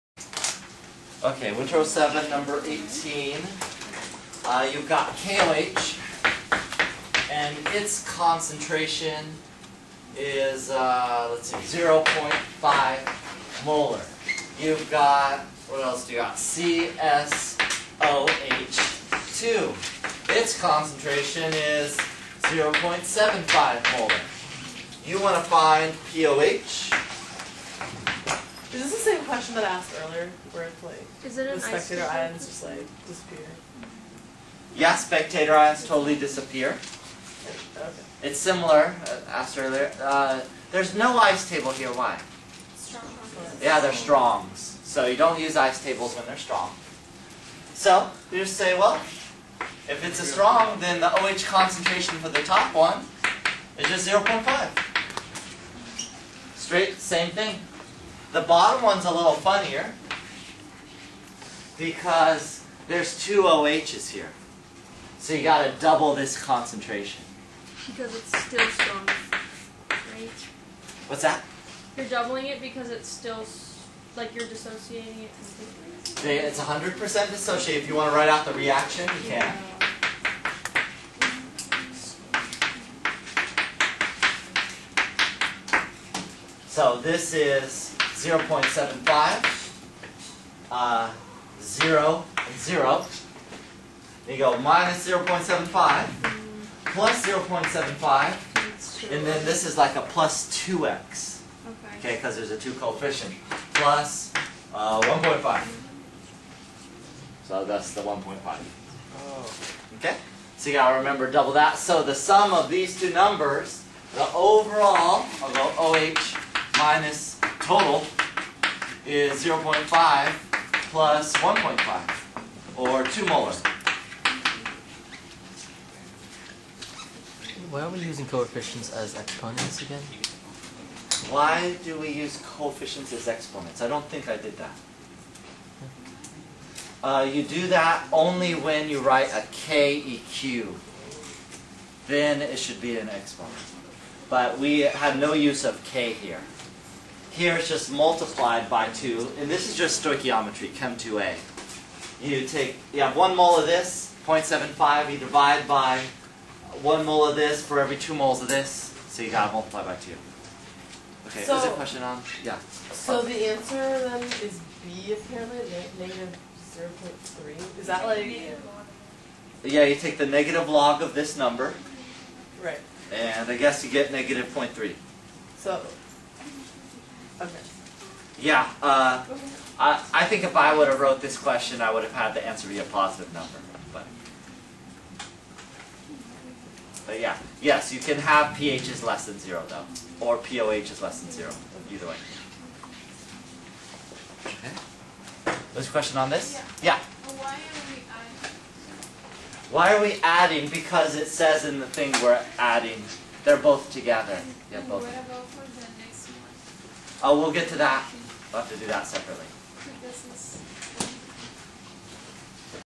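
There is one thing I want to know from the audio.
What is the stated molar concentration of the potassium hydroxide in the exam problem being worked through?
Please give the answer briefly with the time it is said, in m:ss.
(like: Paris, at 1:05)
0.5 molar, at 0:11.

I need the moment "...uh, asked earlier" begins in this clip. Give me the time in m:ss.
0:39.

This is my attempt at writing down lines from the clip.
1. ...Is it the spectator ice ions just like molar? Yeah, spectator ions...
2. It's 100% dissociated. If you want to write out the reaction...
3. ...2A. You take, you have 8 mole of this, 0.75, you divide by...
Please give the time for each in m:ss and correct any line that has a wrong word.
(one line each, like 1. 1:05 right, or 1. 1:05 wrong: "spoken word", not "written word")
1. 0:31 wrong: "disappear", not "molar"
2. 1:16 right
3. 2:30 wrong: "1", not "8".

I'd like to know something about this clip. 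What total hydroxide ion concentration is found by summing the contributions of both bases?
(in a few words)
2 molar.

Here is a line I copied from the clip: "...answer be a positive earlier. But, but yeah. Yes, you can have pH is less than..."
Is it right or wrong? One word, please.
wrong.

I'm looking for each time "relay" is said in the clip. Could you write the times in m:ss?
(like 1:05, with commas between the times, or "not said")
not said.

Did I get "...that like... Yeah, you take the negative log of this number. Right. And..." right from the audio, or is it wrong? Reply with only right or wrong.
right.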